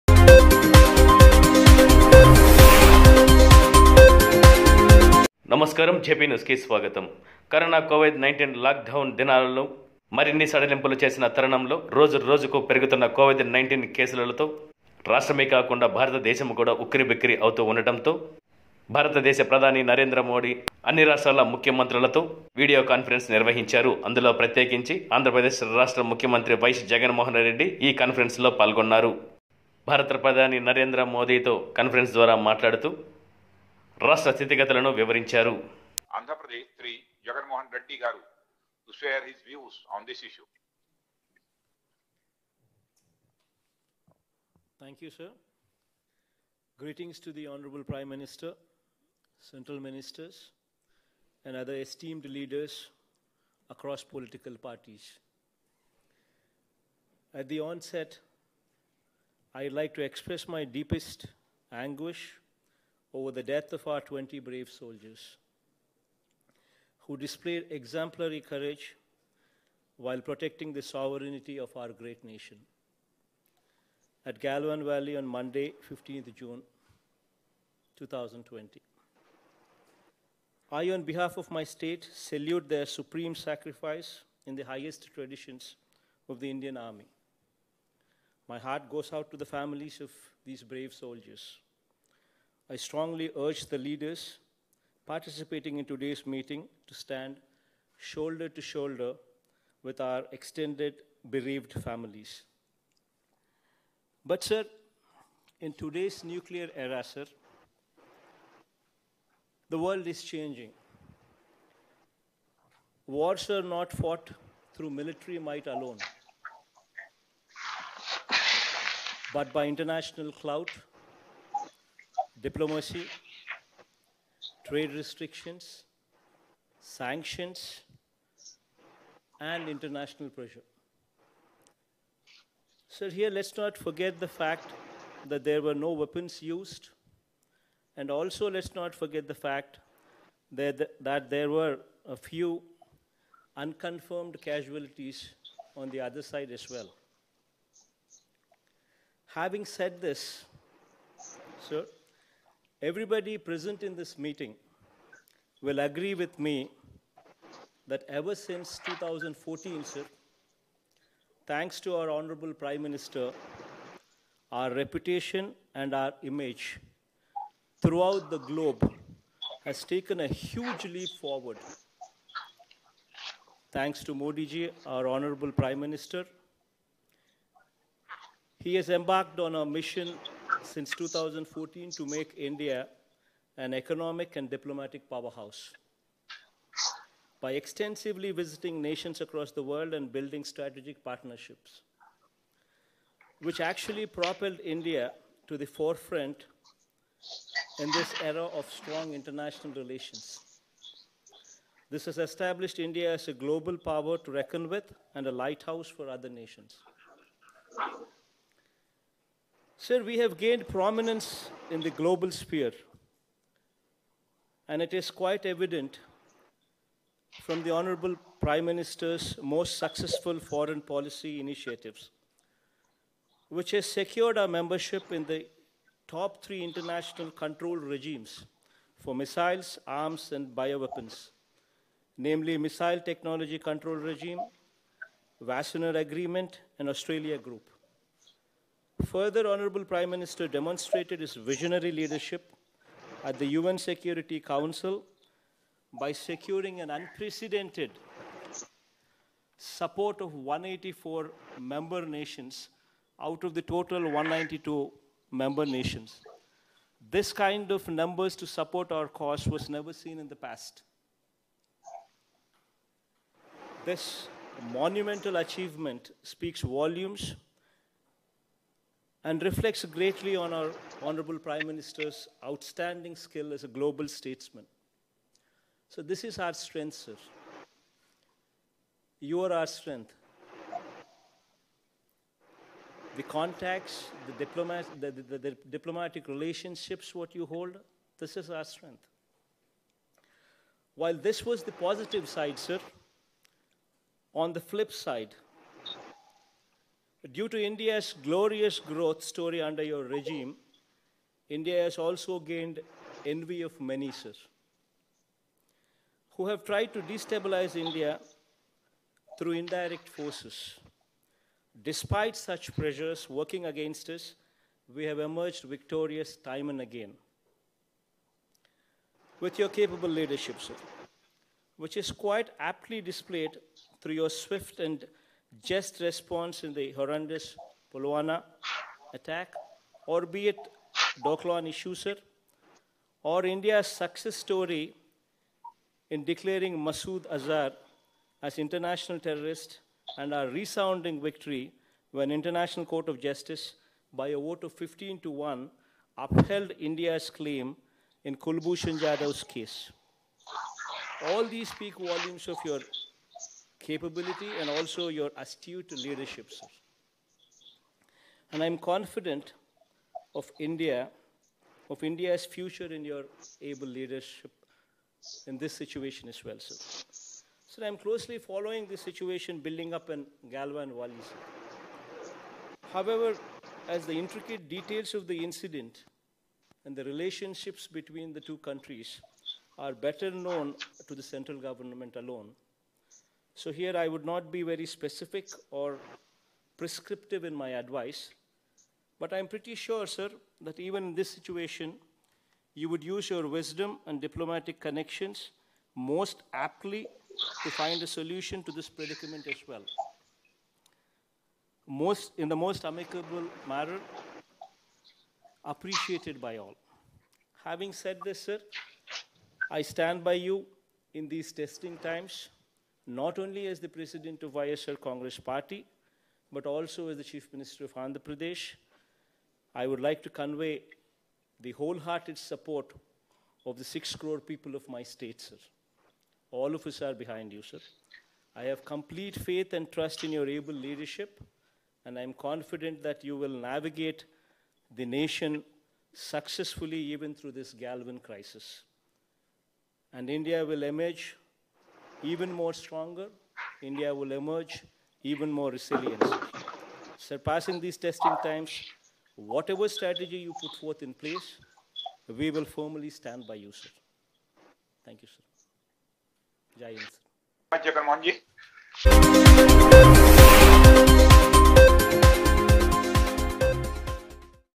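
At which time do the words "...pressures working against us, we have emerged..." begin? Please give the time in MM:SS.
05:12.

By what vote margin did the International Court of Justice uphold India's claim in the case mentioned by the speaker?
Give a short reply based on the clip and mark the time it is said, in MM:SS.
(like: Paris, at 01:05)
15 to 1, at 05:44.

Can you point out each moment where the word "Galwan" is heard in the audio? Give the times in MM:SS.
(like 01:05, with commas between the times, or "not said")
01:14, 06:10, 07:17.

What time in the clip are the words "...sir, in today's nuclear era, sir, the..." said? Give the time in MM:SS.
01:44.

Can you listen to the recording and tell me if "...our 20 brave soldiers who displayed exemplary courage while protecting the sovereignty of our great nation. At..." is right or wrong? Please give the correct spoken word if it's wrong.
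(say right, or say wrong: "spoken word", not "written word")
right.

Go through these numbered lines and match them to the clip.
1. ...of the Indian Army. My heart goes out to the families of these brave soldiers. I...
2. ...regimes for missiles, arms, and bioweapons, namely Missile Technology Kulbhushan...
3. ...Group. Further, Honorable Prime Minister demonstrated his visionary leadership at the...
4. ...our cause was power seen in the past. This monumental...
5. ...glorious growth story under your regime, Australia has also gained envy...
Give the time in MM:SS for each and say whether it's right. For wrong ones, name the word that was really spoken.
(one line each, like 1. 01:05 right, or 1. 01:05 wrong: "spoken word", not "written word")
1. 01:26 right
2. 03:47 wrong: "Control", not "Kulbhushan"
3. 03:57 right
4. 04:18 wrong: "never", not "power"
5. 04:58 wrong: "India", not "Australia".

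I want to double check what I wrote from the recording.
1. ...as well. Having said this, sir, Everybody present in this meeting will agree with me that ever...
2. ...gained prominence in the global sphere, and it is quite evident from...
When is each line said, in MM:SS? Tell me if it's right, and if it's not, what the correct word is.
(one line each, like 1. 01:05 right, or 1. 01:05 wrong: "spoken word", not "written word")
1. 02:26 right
2. 03:30 right.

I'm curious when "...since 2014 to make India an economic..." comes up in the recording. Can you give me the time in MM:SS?
03:00.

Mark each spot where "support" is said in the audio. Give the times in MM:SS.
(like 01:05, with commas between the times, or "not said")
04:09, 04:18, 07:02.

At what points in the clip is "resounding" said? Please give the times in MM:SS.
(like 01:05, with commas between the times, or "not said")
05:40.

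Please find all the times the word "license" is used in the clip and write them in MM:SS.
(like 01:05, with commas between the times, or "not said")
not said.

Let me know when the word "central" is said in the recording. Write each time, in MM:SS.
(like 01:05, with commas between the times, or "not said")
00:49, 06:21.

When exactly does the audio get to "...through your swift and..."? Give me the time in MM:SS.
05:24.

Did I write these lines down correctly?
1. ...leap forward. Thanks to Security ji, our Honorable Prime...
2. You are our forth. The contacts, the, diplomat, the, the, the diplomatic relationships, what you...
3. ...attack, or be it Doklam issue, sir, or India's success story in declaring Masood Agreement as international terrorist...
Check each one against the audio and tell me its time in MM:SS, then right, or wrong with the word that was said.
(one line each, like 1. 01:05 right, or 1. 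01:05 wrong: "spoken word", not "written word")
1. 02:50 wrong: "Modi", not "Security"
2. 04:39 wrong: "strength", not "forth"
3. 05:29 wrong: "Azhar", not "Agreement".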